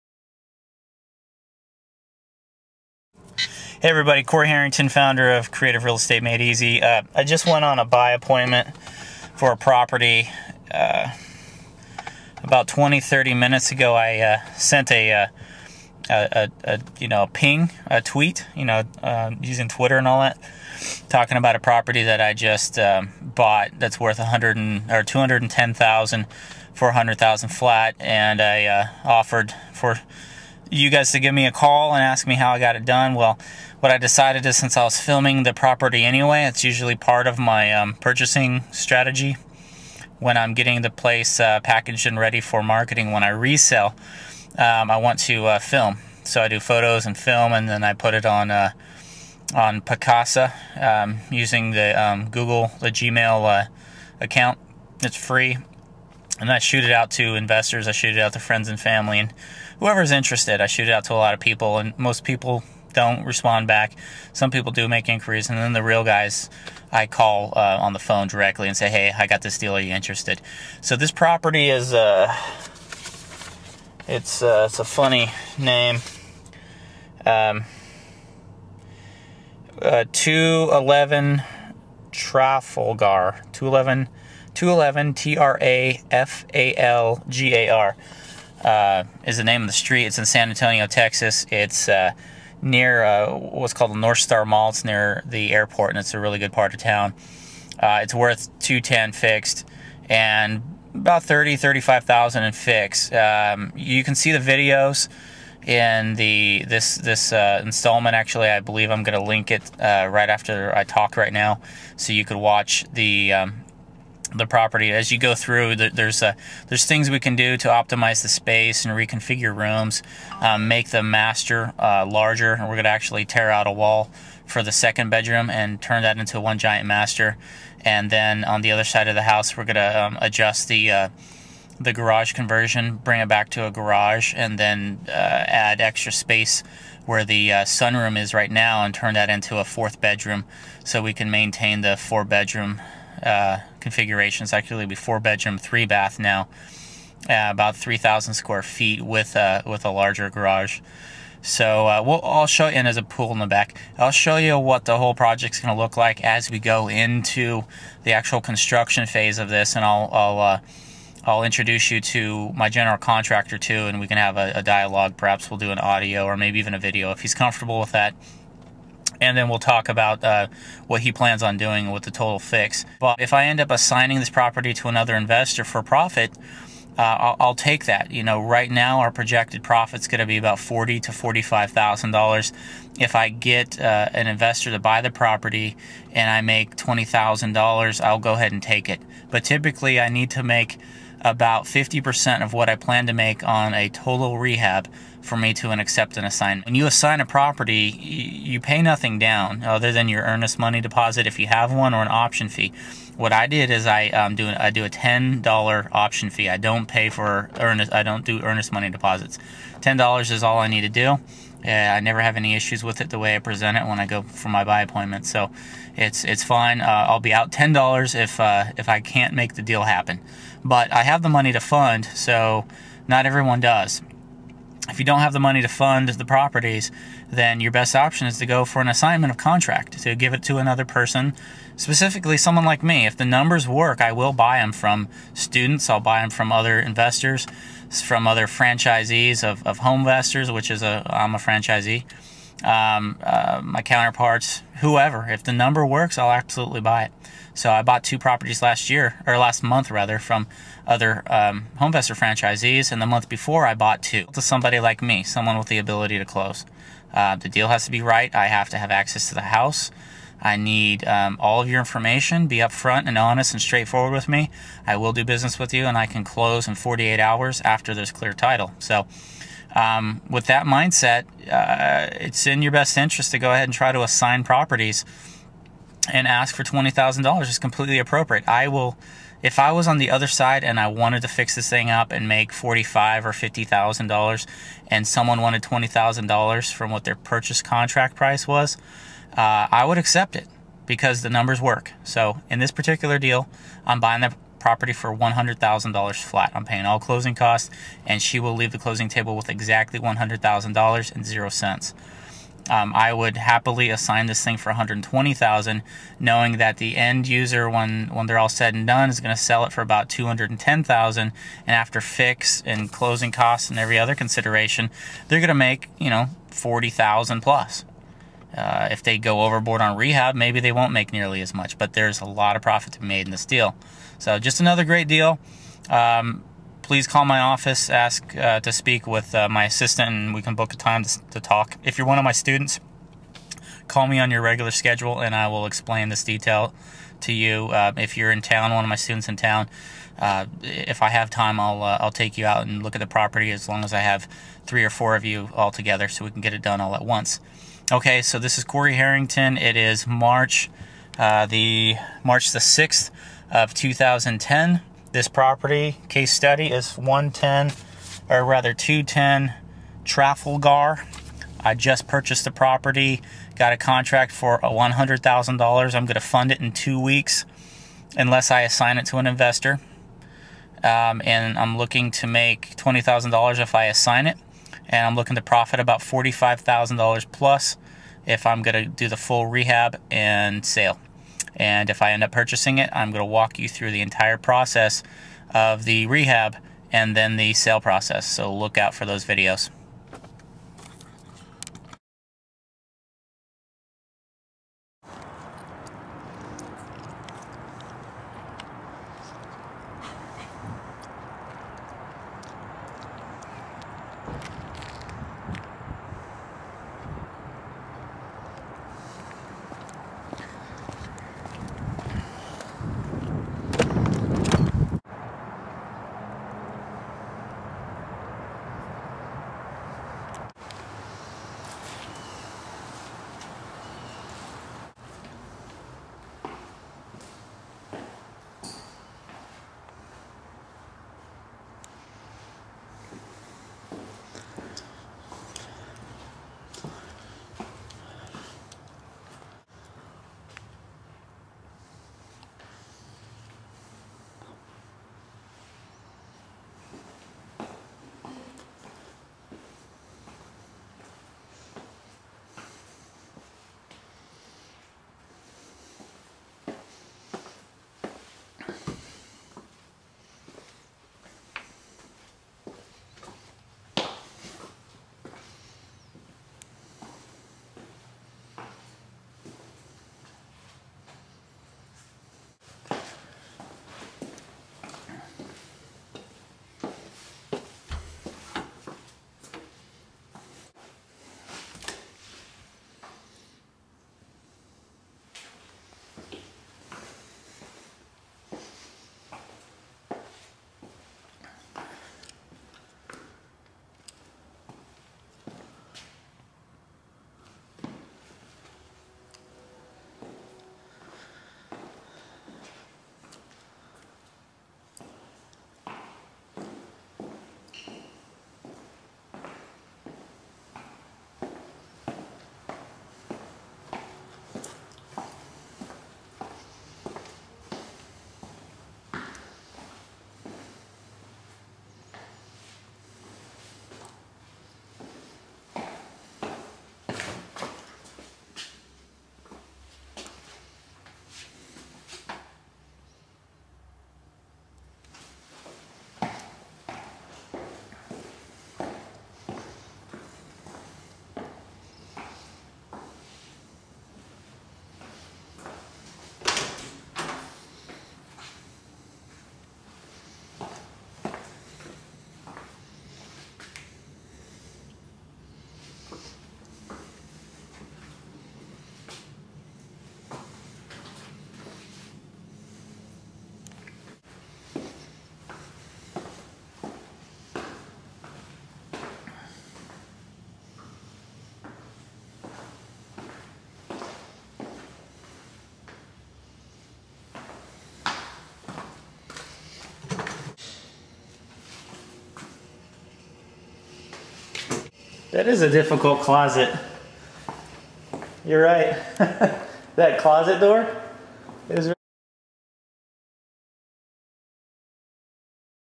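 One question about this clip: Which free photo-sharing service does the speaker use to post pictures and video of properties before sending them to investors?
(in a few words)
Picasa.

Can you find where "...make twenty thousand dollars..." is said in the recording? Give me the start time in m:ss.
3:06.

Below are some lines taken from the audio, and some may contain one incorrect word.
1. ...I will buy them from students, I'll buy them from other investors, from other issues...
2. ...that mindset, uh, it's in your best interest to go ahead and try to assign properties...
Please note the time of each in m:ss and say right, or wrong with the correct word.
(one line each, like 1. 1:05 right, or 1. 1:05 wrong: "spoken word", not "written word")
1. 3:54 wrong: "franchisees", not "issues"
2. 4:30 right.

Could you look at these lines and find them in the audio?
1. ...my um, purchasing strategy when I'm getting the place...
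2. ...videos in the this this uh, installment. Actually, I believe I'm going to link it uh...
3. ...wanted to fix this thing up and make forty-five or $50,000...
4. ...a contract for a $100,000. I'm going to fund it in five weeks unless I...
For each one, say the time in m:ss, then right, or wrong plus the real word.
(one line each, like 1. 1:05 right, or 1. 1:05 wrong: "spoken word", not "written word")
1. 0:37 right
2. 1:44 right
3. 4:40 right
4. 6:03 wrong: "two", not "five".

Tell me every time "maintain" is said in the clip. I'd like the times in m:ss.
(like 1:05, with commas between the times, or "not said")
2:21.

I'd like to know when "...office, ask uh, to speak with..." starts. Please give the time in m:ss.
5:27.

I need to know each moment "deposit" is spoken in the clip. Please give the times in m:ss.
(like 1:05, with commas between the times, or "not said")
3:20, 3:28.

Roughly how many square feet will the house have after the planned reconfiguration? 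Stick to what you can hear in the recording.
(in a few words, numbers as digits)
3,000.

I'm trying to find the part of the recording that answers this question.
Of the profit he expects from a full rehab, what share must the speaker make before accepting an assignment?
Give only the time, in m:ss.
3:11.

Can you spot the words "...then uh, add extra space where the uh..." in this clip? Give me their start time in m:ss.
2:14.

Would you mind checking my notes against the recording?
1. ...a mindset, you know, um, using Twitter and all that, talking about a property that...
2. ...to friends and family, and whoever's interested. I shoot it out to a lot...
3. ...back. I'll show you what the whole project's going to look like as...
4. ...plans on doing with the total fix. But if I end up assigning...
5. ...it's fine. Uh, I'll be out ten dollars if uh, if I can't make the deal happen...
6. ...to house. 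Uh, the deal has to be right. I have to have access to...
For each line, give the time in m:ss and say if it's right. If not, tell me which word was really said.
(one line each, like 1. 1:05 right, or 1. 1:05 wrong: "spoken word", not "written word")
1. 0:17 wrong: "tweet", not "mindset"
2. 0:58 right
3. 2:33 right
4. 2:51 right
5. 3:36 right
6. 4:16 wrong: "close", not "house".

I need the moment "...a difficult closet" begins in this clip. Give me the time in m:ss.
9:45.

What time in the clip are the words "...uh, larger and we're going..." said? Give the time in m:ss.
2:01.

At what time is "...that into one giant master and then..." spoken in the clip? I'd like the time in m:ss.
2:06.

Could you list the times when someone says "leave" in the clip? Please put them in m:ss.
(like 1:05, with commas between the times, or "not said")
4:58.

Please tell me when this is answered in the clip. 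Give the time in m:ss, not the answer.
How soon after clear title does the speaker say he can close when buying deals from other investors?
4:26.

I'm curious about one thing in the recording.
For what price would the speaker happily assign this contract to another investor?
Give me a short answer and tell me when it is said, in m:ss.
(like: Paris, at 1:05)
$120,000, at 5:04.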